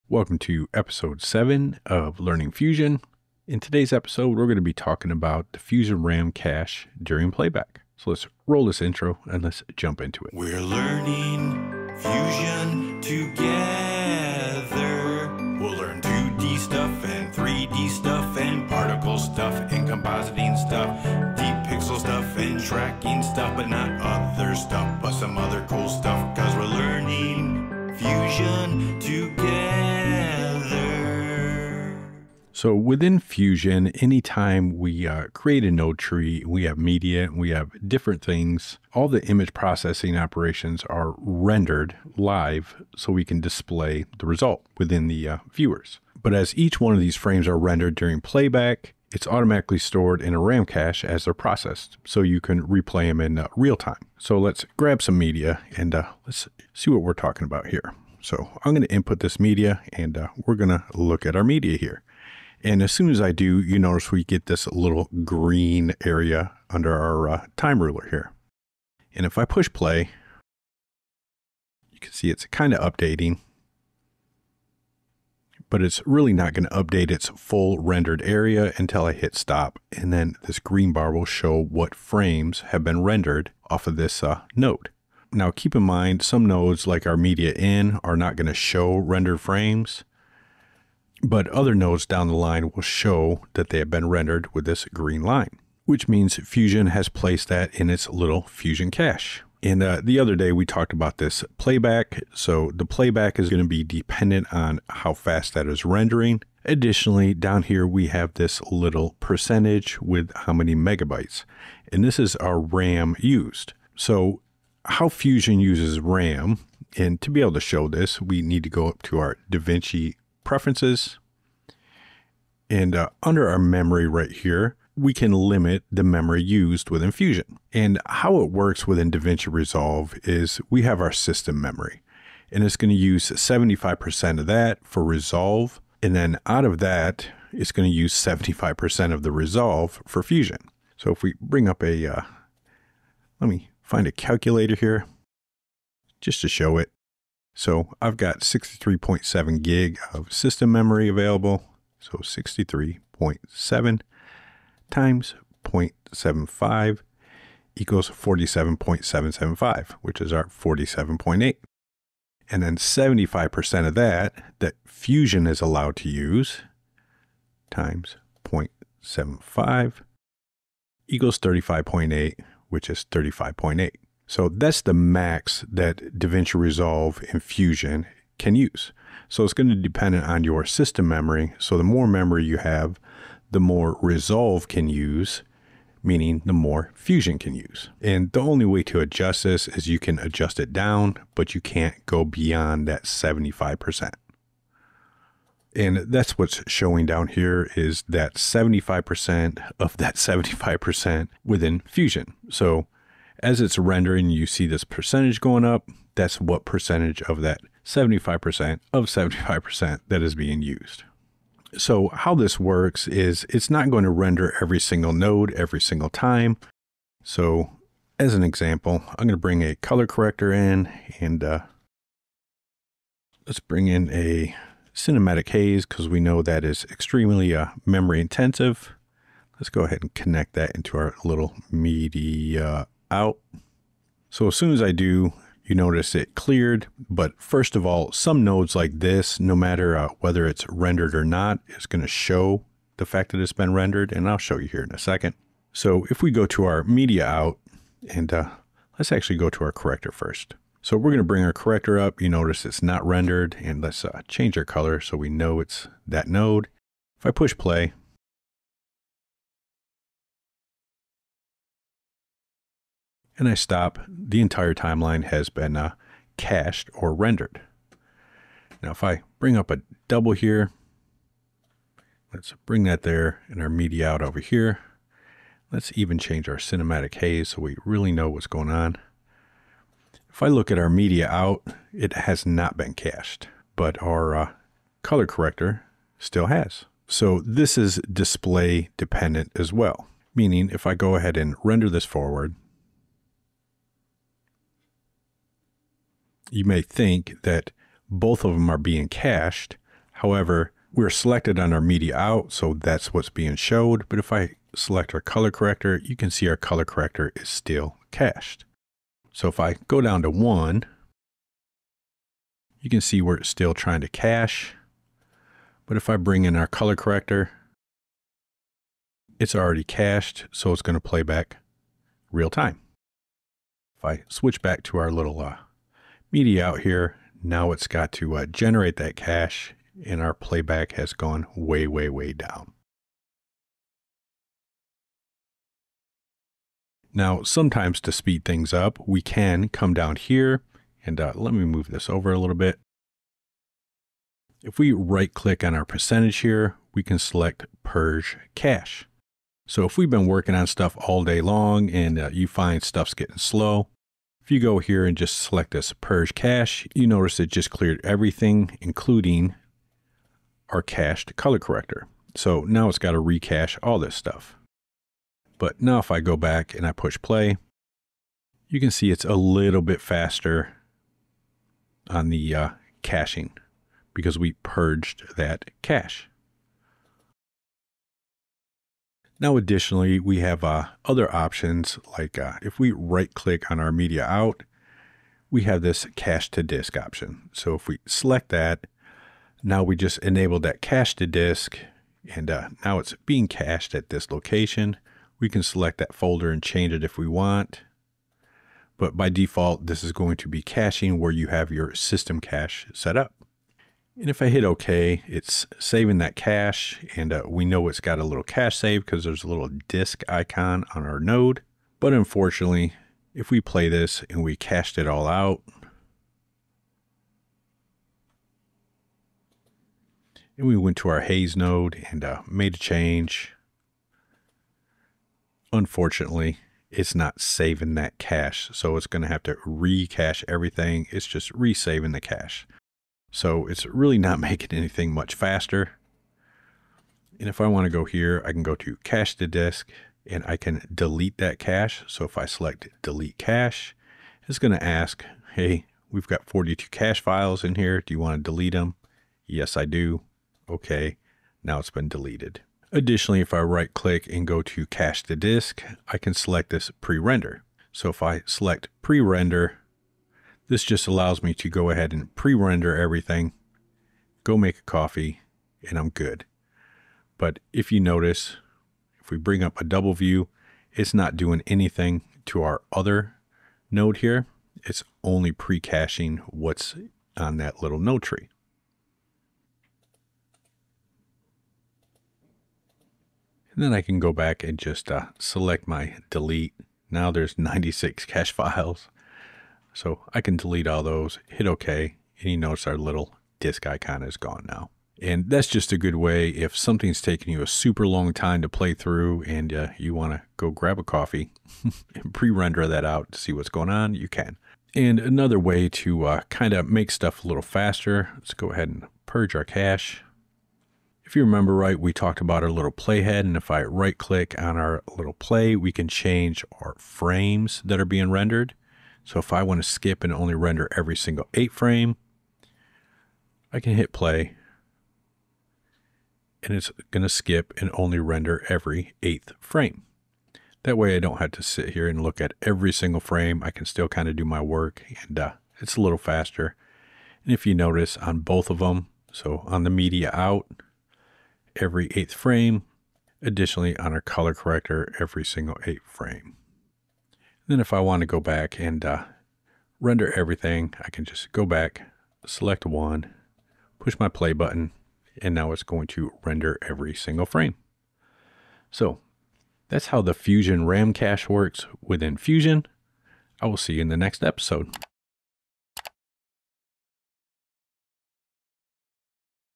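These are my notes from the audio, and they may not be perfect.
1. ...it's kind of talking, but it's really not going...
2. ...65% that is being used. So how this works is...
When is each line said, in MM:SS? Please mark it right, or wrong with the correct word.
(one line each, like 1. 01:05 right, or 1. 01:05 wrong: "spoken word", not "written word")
1. 01:12 wrong: "updating", not "talking"
2. 03:29 wrong: "75", not "65".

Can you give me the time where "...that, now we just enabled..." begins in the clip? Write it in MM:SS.
06:28.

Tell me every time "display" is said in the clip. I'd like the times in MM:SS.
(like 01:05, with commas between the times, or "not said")
00:43, 04:48.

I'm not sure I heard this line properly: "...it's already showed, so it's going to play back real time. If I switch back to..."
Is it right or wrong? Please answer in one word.
wrong.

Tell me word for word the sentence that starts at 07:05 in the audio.
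Unfortunately, it's not saving that cache.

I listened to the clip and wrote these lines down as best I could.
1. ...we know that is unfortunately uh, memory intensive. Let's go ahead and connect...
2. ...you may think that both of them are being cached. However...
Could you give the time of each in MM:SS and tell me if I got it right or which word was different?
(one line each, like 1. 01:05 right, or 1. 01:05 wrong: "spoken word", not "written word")
1. 03:46 wrong: "extremely", not "unfortunately"
2. 04:56 right.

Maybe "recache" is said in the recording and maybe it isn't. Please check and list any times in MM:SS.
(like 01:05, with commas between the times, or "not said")
06:03, 07:09.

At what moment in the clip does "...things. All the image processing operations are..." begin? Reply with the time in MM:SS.
00:38.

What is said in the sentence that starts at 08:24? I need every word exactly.
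And another way to uh, kind of make stuff a little faster, let's go ahead and purge our cache.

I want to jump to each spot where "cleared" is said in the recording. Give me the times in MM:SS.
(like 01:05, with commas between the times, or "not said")
03:56, 05:57.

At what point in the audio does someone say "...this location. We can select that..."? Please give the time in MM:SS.
06:34.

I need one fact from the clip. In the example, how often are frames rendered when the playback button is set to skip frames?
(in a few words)
Every 8th frame.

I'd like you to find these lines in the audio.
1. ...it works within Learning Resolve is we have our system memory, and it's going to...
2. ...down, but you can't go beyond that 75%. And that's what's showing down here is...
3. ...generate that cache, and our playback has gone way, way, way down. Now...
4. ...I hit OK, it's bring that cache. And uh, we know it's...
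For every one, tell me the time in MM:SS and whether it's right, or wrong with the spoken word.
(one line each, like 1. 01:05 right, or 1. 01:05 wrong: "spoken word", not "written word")
1. 02:08 wrong: "DaVinci", not "Learning"
2. 03:10 right
3. 05:28 right
4. 06:44 wrong: "saving", not "bring".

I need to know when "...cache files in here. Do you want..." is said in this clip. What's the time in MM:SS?
07:26.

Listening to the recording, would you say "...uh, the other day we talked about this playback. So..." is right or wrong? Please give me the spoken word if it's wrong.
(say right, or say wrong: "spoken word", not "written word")
right.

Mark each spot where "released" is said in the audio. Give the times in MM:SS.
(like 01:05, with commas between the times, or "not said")
not said.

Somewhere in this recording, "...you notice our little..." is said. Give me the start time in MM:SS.
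08:12.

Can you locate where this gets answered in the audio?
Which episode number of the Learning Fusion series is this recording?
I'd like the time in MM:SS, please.
00:00.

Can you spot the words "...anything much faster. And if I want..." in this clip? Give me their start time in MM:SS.
07:14.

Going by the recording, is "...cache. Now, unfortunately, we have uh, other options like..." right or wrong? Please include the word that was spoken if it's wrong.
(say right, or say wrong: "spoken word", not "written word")
wrong: "additionally", not "unfortunately".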